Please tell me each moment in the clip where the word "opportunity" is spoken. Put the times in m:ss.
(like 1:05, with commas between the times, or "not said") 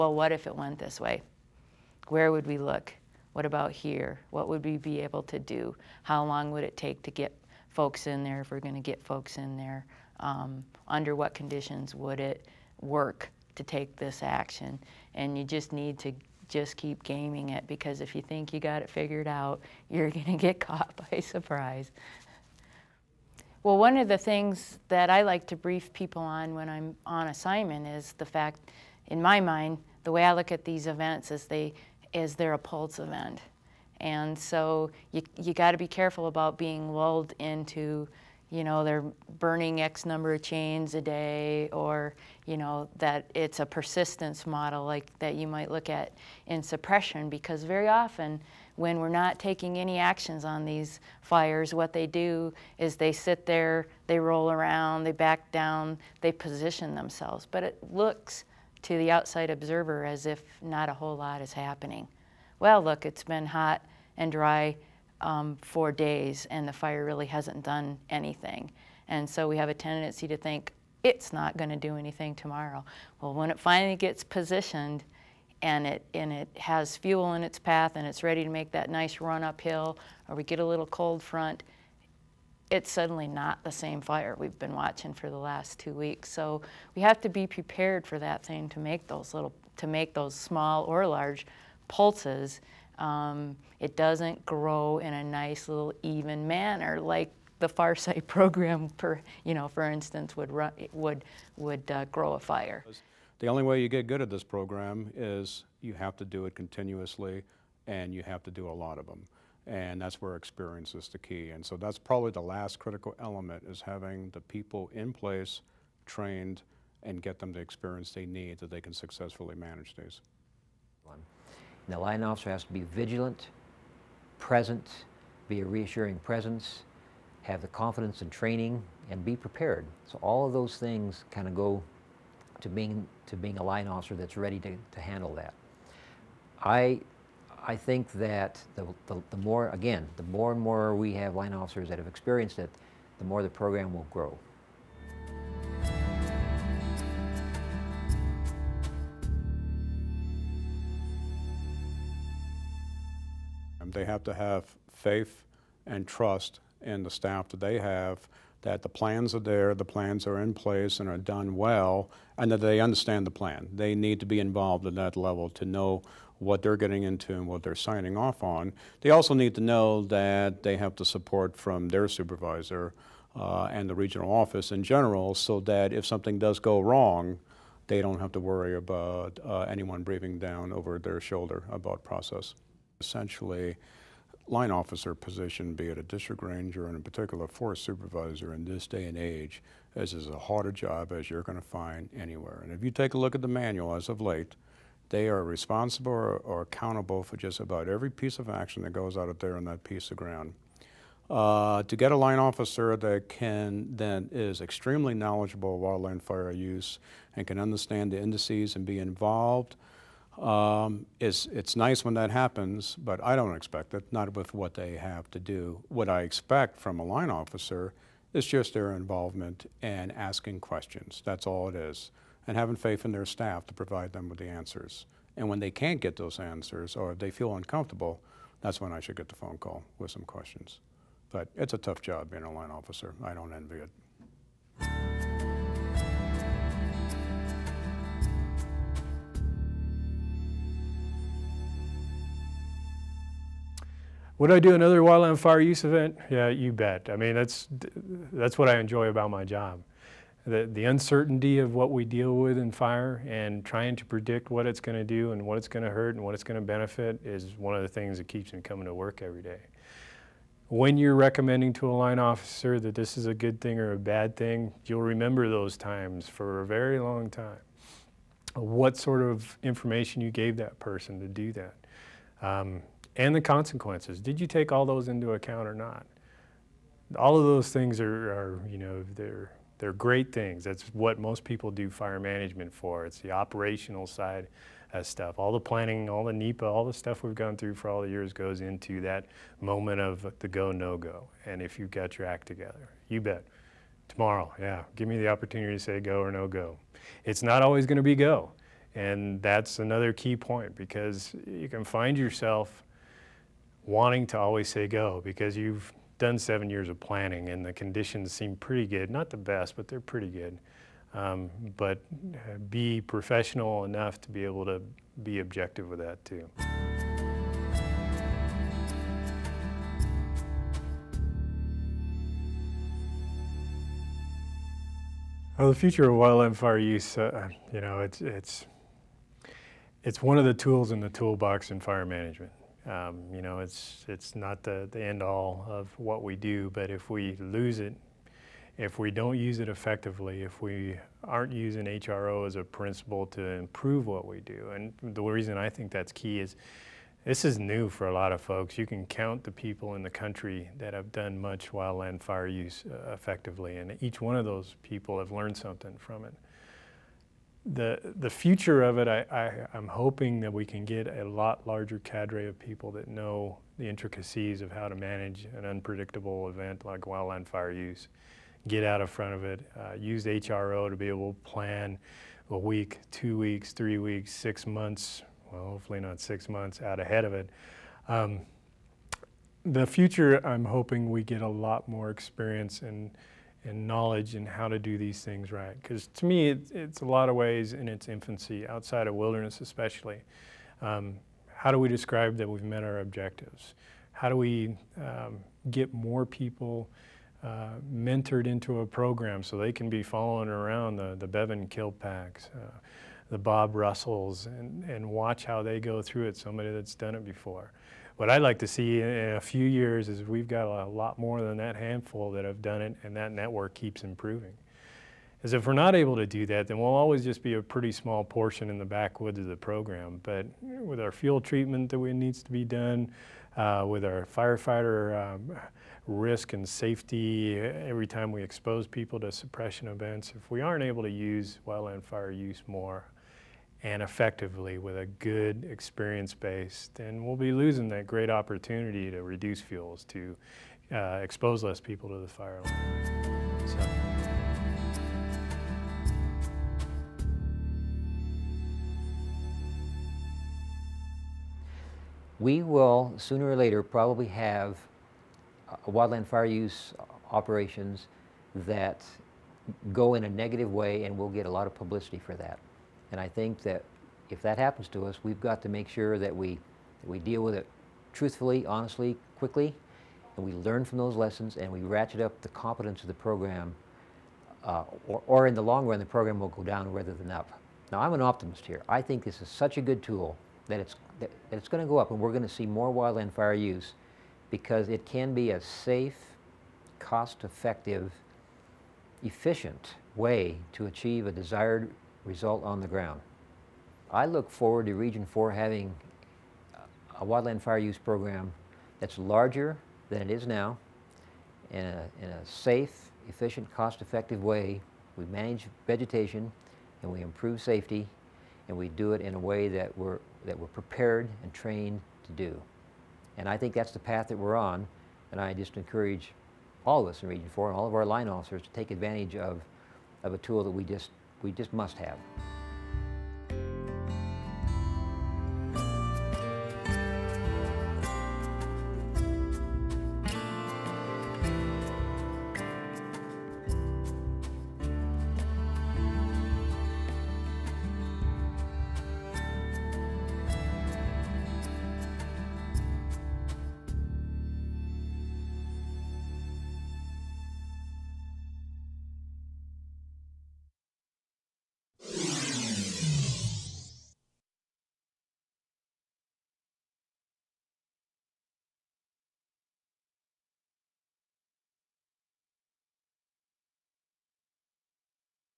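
4:55, 7:18.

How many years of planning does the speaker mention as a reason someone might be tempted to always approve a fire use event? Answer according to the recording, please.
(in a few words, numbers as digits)
7.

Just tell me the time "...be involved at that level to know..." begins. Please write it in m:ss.
2:44.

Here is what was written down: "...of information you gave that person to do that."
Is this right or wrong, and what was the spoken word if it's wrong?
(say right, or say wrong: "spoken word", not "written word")
right.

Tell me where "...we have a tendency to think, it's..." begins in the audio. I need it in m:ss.
1:09.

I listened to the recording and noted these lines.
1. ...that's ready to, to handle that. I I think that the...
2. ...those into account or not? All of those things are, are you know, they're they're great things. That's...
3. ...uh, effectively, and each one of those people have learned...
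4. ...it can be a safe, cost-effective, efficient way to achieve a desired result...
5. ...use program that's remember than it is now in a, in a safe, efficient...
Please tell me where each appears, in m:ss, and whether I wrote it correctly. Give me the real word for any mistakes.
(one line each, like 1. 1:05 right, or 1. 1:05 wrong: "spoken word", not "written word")
1. 2:14 right
2. 4:34 right
3. 5:52 right
4. 8:04 right
5. 8:17 wrong: "larger", not "remember".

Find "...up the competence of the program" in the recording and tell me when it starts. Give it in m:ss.
7:52.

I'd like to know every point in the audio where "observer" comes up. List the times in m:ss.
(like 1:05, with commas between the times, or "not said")
0:59.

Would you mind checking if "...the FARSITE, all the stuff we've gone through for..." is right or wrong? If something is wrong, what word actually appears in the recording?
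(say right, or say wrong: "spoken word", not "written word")
wrong: "NEPA", not "FARSITE".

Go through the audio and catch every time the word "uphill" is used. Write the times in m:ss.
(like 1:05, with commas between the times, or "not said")
1:19.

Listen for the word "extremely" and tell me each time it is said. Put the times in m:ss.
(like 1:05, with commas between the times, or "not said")
3:24.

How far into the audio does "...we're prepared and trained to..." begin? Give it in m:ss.
8:30.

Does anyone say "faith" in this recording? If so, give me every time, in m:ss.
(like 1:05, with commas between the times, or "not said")
2:34, 3:42.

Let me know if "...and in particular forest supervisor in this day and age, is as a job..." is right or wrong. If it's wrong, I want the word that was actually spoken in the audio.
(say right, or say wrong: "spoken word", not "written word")
right.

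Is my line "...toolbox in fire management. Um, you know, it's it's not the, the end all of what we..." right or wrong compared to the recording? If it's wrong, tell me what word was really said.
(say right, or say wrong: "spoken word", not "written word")
right.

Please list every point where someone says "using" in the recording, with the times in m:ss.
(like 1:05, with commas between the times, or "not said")
5:41.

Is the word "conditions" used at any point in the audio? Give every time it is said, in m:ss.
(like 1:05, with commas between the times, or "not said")
0:11, 5:07.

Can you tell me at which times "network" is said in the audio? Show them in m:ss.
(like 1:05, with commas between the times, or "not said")
6:53.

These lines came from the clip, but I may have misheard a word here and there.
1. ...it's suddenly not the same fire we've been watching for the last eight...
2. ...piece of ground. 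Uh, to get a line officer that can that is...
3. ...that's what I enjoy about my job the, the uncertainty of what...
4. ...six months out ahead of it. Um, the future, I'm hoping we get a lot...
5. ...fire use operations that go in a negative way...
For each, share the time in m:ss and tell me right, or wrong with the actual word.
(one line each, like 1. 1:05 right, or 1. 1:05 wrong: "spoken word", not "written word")
1. 1:22 wrong: "two", not "eight"
2. 3:19 right
3. 4:08 right
4. 6:16 right
5. 7:36 right.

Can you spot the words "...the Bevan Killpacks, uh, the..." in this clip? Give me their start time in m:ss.
6:41.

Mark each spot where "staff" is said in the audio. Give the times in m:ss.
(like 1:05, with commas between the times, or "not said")
2:37, 3:43.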